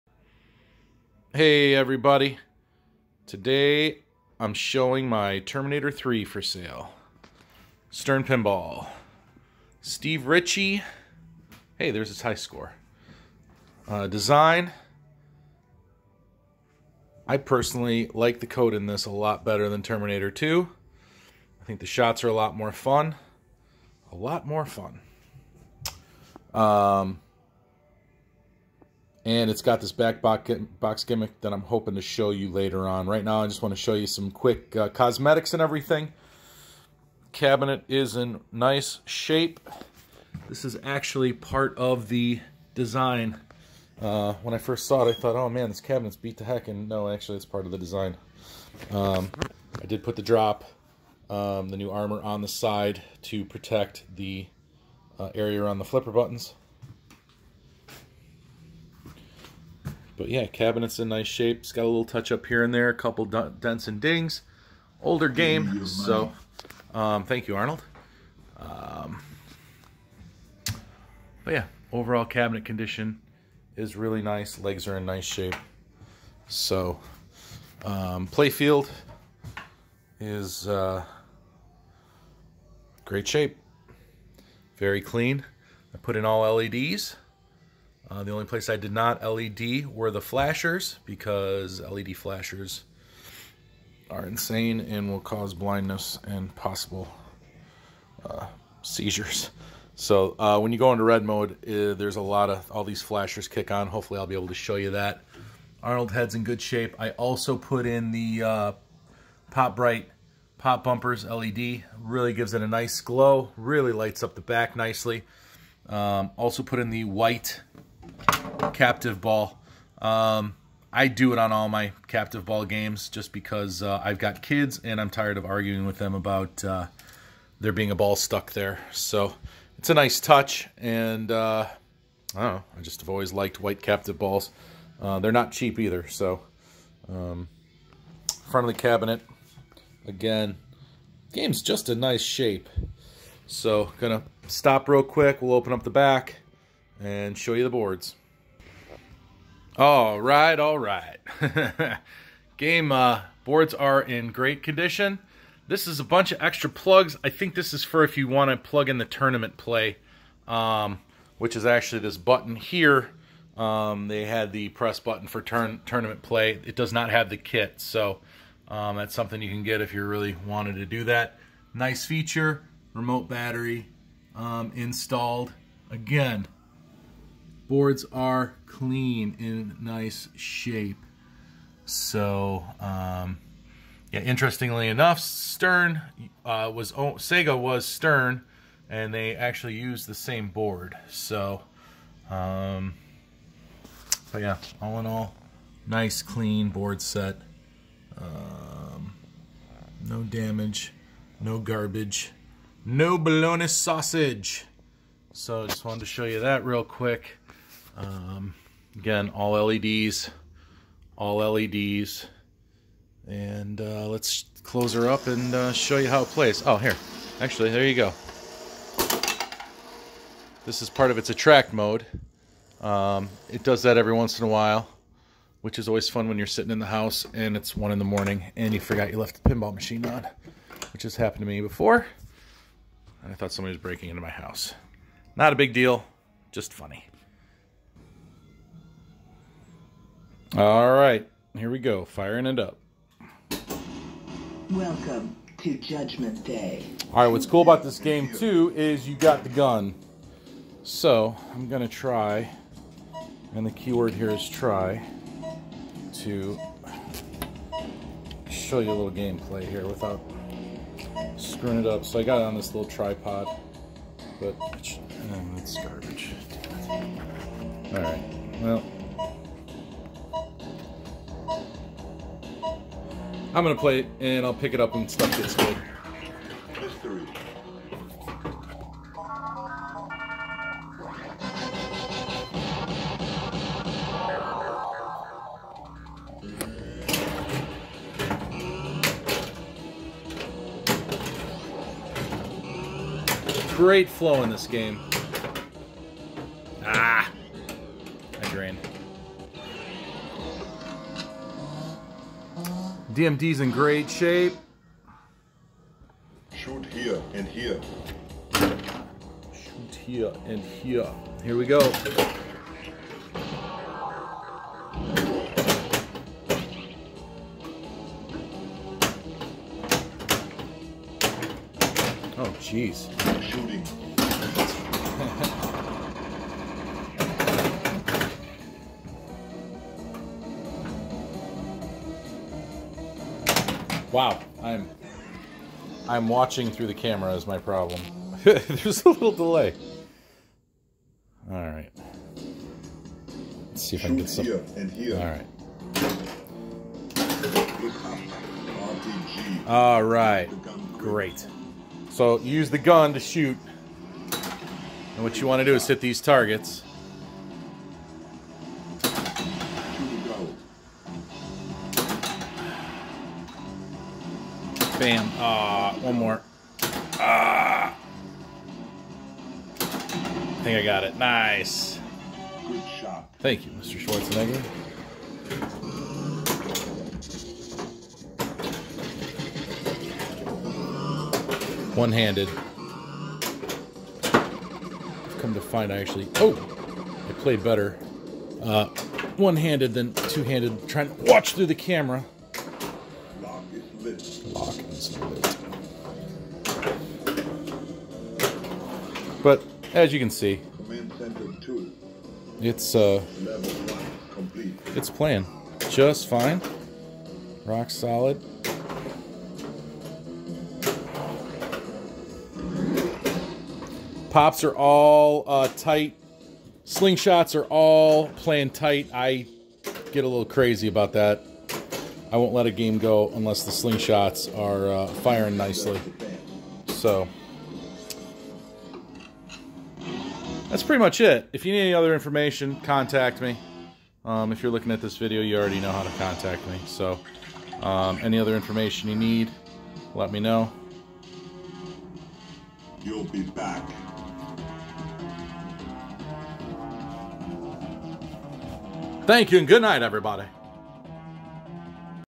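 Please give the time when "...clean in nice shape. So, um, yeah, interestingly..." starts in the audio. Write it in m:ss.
2:58.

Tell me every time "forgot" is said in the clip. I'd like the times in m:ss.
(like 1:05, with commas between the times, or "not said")
3:48.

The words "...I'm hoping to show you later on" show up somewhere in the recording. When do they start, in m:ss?
0:31.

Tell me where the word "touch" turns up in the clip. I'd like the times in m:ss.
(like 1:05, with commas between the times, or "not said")
1:02, 2:10.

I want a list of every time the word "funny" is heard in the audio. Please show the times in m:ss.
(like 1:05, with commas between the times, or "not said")
3:56.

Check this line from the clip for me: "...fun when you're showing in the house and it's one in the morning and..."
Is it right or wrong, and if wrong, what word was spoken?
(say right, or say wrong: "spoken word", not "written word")
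wrong: "sitting", not "showing".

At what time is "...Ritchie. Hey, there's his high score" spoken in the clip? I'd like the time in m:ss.
0:10.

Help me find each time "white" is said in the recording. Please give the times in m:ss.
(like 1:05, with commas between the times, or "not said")
1:57, 2:13.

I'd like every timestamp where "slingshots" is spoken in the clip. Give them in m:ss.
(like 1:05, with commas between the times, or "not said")
6:56, 7:03.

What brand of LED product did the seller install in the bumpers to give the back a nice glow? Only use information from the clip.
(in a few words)
Pop Bright.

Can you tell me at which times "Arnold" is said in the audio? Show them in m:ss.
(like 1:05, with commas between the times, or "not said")
1:07, 1:45.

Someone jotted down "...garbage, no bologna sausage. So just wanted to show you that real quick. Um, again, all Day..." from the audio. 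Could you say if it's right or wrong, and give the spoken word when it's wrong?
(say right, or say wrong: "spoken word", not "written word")
wrong: "LEDs", not "Day".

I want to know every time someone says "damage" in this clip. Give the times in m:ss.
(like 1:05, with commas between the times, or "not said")
3:20.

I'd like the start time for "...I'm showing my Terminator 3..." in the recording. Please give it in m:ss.
0:04.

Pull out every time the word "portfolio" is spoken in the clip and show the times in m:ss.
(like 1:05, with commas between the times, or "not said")
not said.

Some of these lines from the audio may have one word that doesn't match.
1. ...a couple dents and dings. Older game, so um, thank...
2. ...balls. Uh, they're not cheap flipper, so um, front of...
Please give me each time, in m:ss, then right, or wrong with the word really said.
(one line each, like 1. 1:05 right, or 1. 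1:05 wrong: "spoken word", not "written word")
1. 1:02 right
2. 2:14 wrong: "either", not "flipper".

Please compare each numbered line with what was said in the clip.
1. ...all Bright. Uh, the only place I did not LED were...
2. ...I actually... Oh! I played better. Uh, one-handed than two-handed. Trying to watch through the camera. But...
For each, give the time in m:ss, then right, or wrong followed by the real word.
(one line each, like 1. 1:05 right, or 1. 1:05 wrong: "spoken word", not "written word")
1. 1:26 wrong: "LEDs", not "Bright"
2. 6:25 right.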